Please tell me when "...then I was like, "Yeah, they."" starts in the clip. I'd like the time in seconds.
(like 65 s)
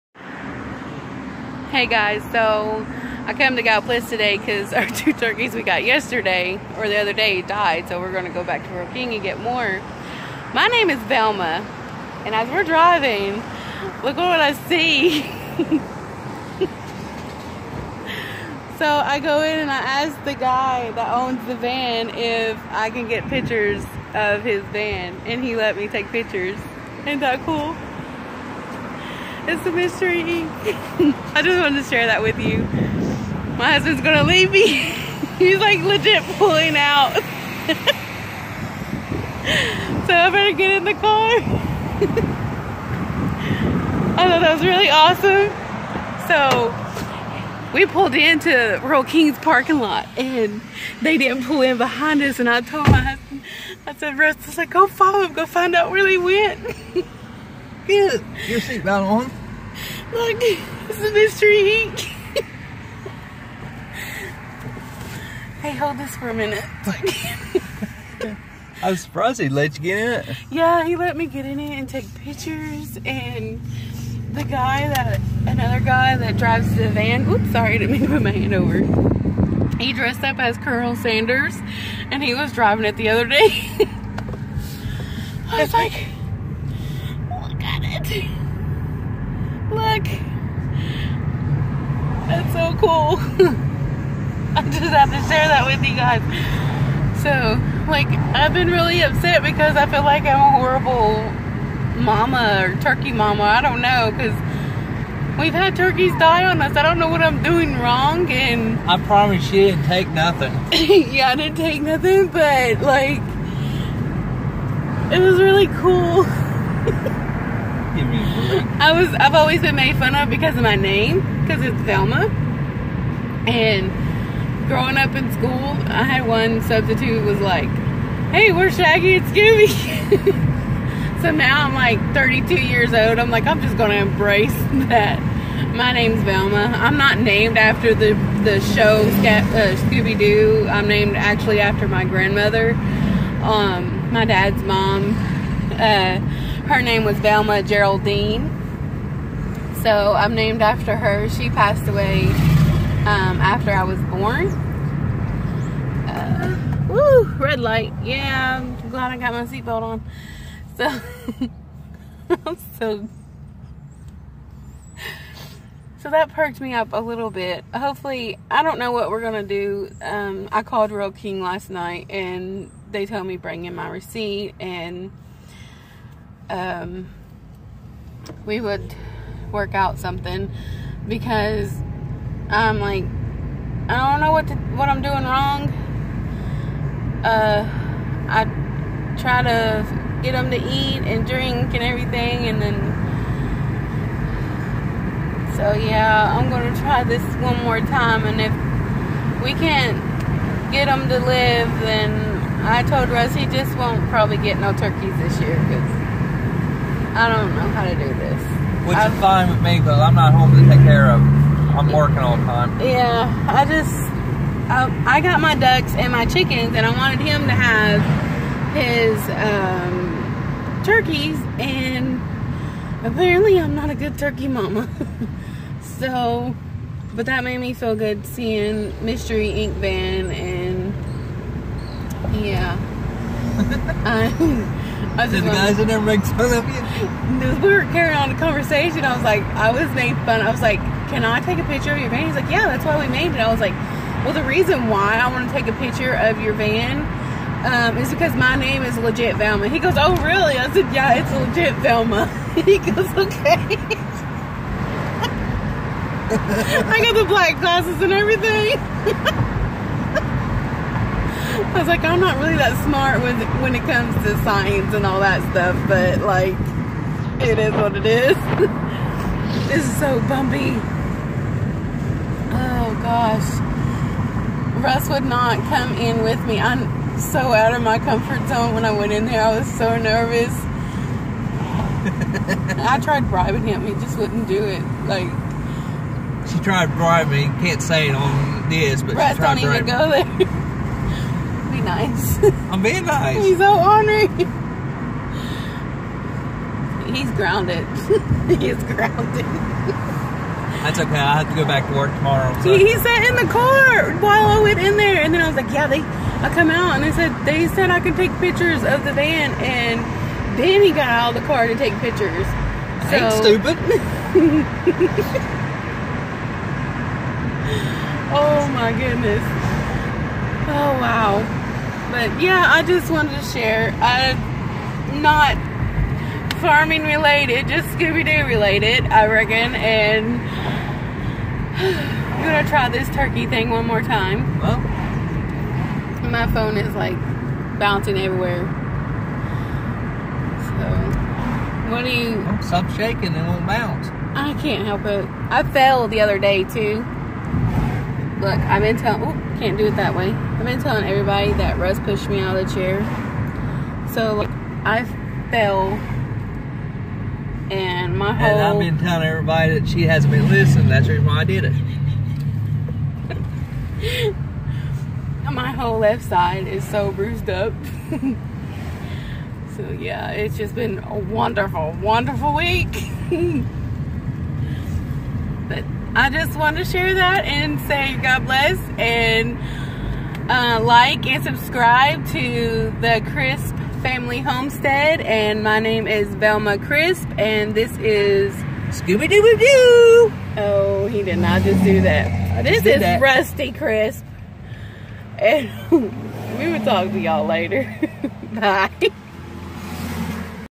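305 s.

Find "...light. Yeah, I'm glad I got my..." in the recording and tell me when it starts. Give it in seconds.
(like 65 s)
157 s.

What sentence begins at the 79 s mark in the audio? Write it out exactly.
He dressed up as Colonel Sanders and he was driving it the other day.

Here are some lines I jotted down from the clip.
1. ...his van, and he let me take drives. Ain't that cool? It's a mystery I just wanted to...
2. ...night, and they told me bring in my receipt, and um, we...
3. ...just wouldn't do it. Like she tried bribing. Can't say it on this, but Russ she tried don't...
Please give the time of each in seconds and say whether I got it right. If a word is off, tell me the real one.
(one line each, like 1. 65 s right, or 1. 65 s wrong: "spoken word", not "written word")
1. 24 s wrong: "pictures", not "drives"
2. 171 s right
3. 283 s right.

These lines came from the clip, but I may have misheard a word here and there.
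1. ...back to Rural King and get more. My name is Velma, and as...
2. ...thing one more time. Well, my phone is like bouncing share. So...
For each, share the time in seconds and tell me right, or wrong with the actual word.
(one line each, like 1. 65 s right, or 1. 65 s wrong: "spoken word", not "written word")
1. 8 s right
2. 333 s wrong: "everywhere", not "share".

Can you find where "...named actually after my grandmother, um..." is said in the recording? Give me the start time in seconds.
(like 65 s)
140 s.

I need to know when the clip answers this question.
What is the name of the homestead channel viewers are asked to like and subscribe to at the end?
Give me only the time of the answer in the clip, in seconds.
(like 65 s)
383 s.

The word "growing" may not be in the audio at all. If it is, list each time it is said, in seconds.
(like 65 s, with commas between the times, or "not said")
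124 s.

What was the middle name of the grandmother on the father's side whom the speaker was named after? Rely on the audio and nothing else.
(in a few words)
Geraldine.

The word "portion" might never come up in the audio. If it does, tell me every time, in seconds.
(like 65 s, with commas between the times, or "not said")
not said.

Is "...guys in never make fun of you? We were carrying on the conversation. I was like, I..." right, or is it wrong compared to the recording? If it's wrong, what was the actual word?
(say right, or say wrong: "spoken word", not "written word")
right.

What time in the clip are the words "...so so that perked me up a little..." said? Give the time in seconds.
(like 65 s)
162 s.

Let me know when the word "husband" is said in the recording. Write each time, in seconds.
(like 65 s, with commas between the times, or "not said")
33 s, 53 s.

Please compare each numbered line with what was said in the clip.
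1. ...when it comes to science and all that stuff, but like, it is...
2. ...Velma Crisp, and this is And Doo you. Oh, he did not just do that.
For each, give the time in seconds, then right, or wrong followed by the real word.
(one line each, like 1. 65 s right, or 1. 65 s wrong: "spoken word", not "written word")
1. 263 s right
2. 386 s wrong: "Scooby", not "And".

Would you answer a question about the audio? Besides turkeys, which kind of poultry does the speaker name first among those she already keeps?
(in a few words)
ducks.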